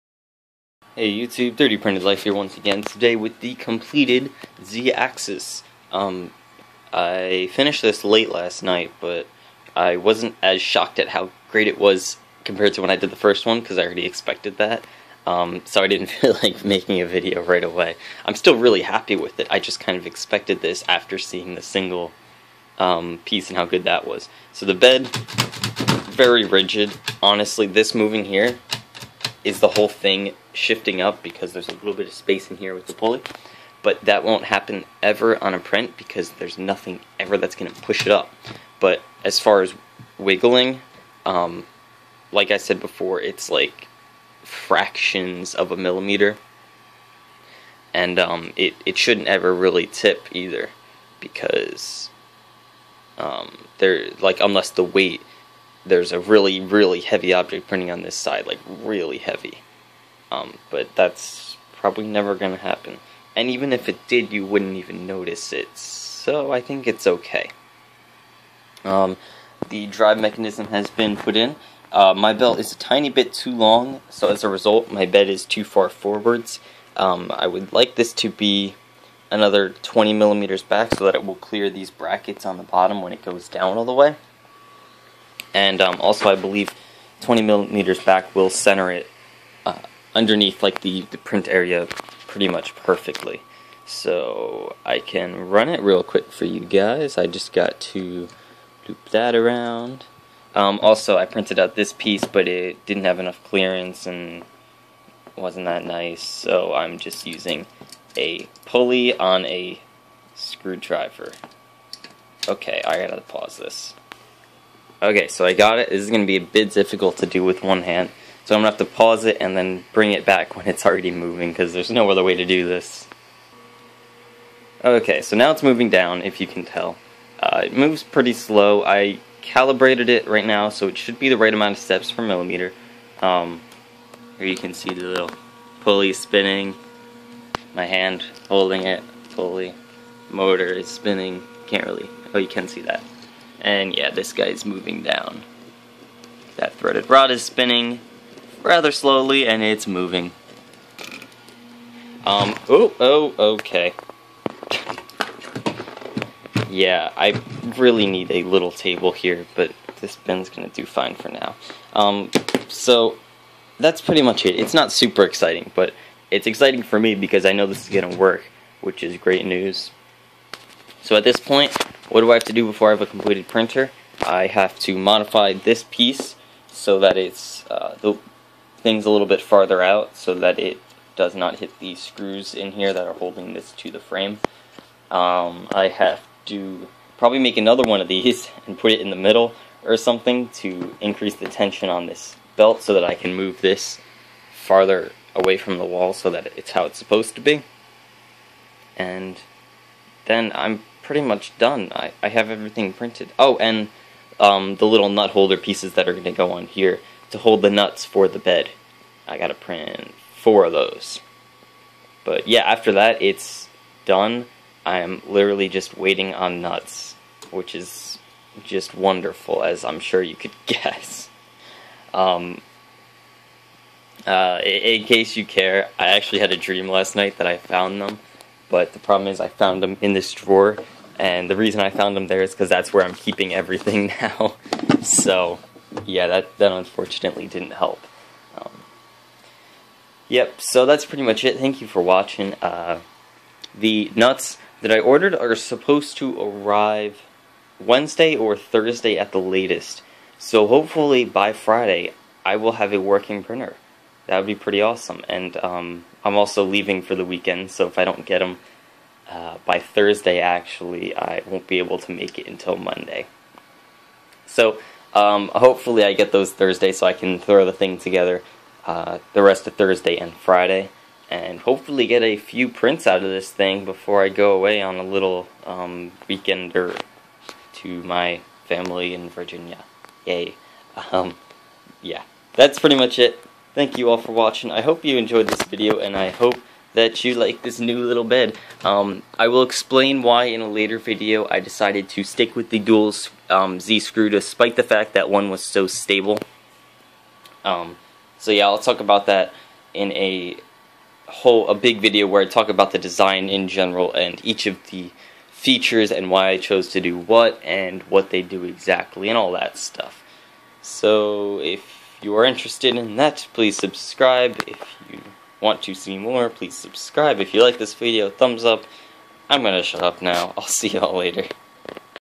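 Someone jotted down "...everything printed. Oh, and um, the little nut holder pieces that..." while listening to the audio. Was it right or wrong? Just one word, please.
right.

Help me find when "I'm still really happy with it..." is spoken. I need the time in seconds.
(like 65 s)
18 s.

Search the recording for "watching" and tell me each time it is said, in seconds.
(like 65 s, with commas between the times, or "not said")
242 s, 284 s.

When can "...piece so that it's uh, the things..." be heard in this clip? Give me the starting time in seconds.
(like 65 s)
175 s.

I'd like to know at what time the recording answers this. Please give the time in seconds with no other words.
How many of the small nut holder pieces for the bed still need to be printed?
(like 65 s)
210 s.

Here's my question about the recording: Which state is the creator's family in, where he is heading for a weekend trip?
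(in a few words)
Virginia.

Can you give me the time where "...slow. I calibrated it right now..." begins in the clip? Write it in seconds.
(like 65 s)
128 s.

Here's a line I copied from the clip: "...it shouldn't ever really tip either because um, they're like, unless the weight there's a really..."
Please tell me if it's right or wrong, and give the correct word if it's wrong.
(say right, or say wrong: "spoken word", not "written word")
right.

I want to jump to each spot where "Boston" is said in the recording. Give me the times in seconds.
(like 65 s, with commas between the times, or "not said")
not said.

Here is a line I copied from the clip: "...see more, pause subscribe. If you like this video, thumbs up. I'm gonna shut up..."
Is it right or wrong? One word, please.
wrong.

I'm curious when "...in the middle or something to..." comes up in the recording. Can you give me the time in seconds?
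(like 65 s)
188 s.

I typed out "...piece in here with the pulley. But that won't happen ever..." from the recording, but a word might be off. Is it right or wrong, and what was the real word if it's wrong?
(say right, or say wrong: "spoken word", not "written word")
wrong: "space", not "piece".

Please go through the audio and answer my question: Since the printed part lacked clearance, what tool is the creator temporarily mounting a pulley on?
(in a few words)
screwdriver.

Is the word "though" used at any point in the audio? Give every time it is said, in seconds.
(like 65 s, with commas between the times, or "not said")
not said.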